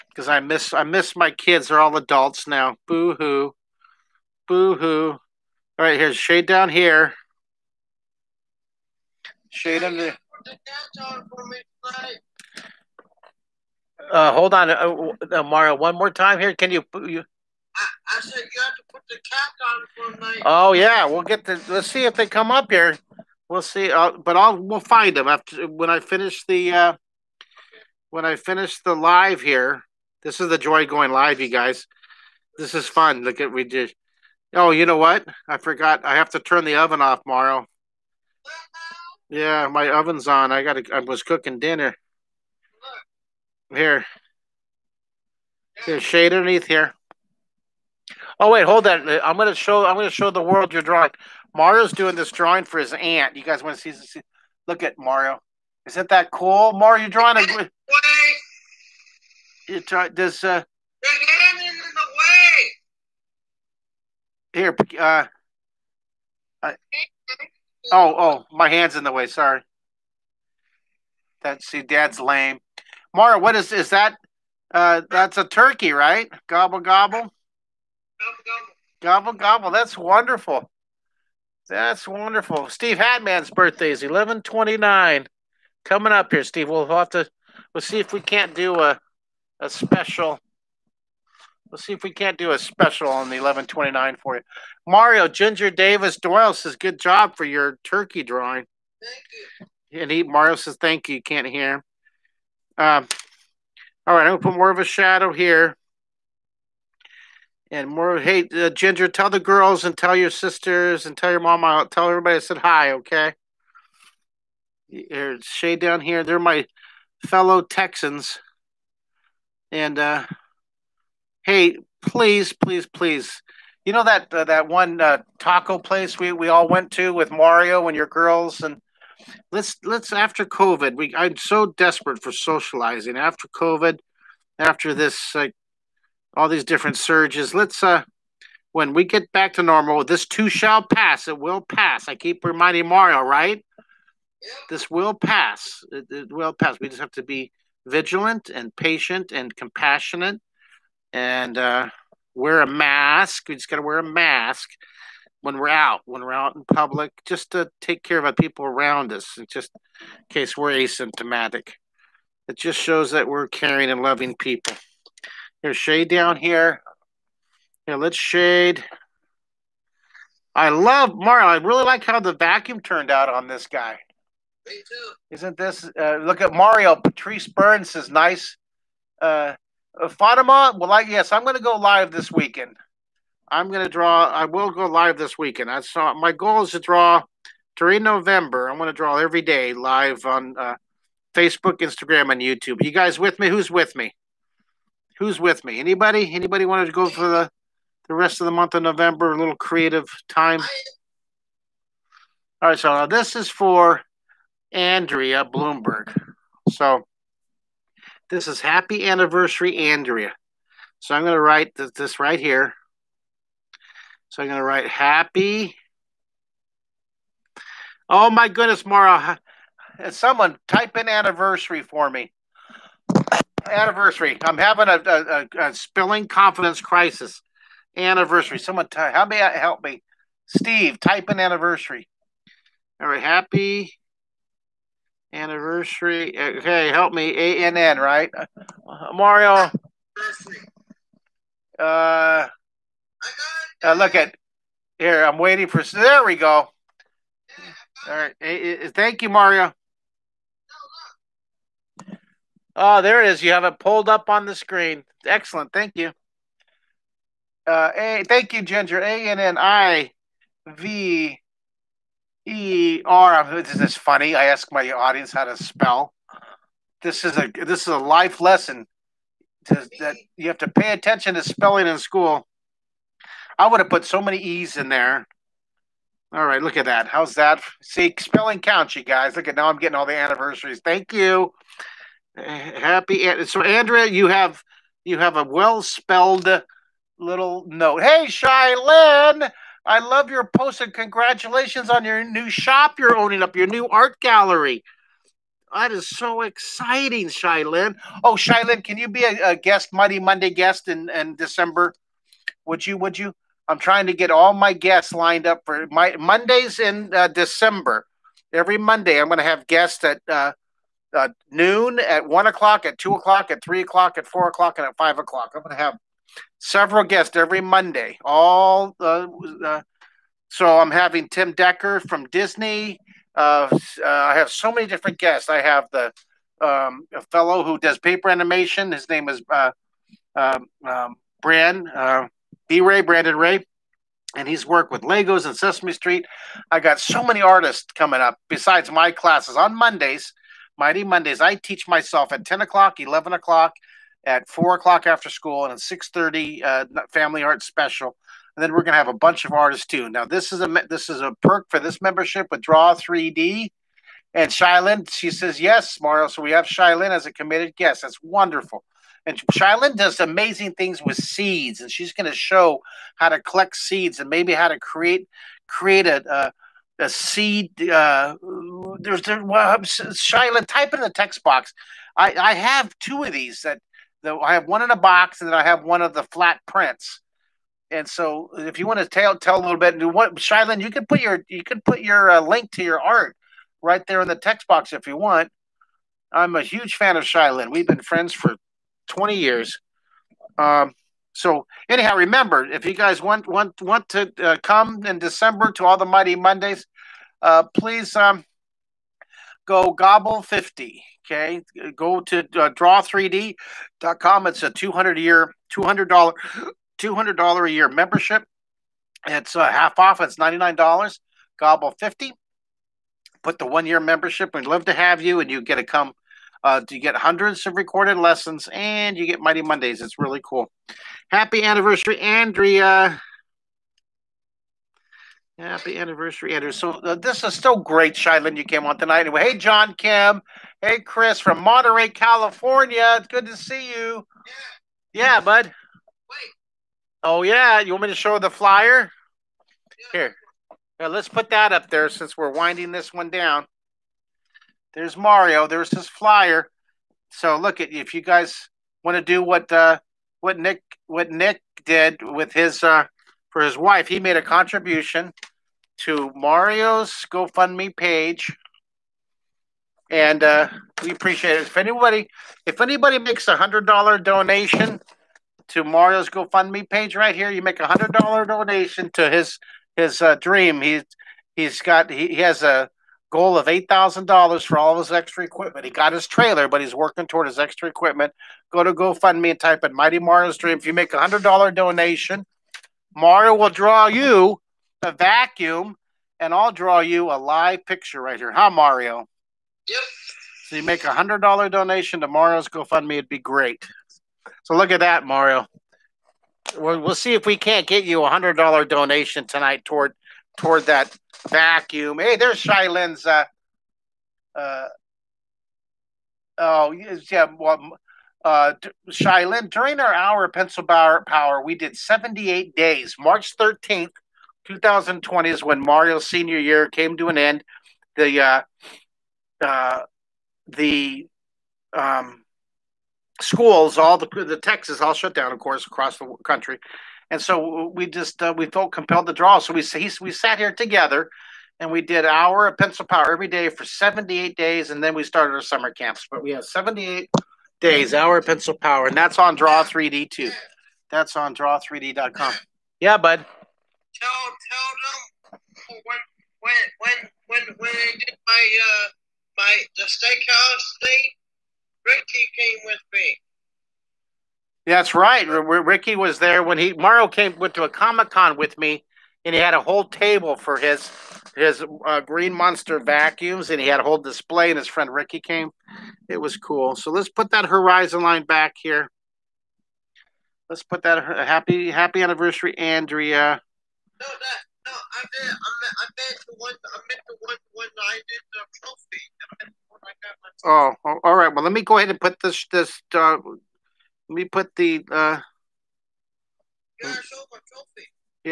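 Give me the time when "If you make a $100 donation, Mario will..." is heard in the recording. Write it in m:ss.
8:00.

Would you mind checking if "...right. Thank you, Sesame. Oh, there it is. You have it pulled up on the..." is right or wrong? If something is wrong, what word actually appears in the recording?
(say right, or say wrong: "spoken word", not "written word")
wrong: "Mario", not "Sesame".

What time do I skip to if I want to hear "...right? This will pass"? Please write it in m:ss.
2:23.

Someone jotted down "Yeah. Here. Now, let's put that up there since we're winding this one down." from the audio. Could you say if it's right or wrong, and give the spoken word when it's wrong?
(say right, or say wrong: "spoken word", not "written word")
right.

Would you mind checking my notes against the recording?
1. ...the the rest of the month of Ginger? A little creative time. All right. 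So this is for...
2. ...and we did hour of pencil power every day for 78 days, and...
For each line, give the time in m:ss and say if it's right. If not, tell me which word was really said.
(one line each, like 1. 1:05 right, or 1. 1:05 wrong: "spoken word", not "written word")
1. 3:17 wrong: "November", not "Ginger"
2. 8:51 right.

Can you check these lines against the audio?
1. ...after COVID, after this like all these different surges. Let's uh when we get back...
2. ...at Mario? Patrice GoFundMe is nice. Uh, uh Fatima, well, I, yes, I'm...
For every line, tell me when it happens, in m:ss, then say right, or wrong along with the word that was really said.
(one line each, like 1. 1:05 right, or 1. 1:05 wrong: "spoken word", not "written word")
1. 2:13 right
2. 2:56 wrong: "Burns", not "GoFundMe".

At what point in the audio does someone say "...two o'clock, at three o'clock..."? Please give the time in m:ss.
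5:12.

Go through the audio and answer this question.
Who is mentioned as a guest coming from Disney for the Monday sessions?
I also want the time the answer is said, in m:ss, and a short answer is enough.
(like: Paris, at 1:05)
Tim Decker, at 5:21.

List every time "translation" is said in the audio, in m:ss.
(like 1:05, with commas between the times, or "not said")
not said.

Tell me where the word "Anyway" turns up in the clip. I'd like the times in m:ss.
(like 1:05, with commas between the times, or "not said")
7:09.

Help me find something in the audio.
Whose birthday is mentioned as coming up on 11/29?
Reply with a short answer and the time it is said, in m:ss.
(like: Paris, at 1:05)
Steve Hatman, at 1:22.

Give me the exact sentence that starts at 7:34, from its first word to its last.
He made a contribution to Mario's GoFundMe page, and uh, we appreciate it.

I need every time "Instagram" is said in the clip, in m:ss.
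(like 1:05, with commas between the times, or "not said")
3:11.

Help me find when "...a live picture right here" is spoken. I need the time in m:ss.
8:07.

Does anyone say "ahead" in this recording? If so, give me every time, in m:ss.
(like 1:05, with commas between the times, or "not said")
9:41.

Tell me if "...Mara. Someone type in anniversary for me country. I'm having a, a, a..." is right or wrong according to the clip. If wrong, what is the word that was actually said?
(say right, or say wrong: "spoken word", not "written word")
wrong: "anniversary", not "country".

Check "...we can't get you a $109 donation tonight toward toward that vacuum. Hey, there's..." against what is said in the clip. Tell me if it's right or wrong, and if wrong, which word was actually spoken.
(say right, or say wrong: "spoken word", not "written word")
wrong: "100", not "109".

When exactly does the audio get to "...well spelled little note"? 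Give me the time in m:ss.
4:45.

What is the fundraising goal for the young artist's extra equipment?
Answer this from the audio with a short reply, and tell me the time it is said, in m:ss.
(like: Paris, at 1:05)
$8,000, at 7:53.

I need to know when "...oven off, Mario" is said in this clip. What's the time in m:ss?
0:36.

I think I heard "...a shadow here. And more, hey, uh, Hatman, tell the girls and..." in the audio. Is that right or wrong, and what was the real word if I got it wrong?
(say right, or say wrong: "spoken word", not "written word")
wrong: "Ginger", not "Hatman".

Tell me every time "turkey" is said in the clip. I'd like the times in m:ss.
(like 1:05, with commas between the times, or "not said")
1:15, 1:37.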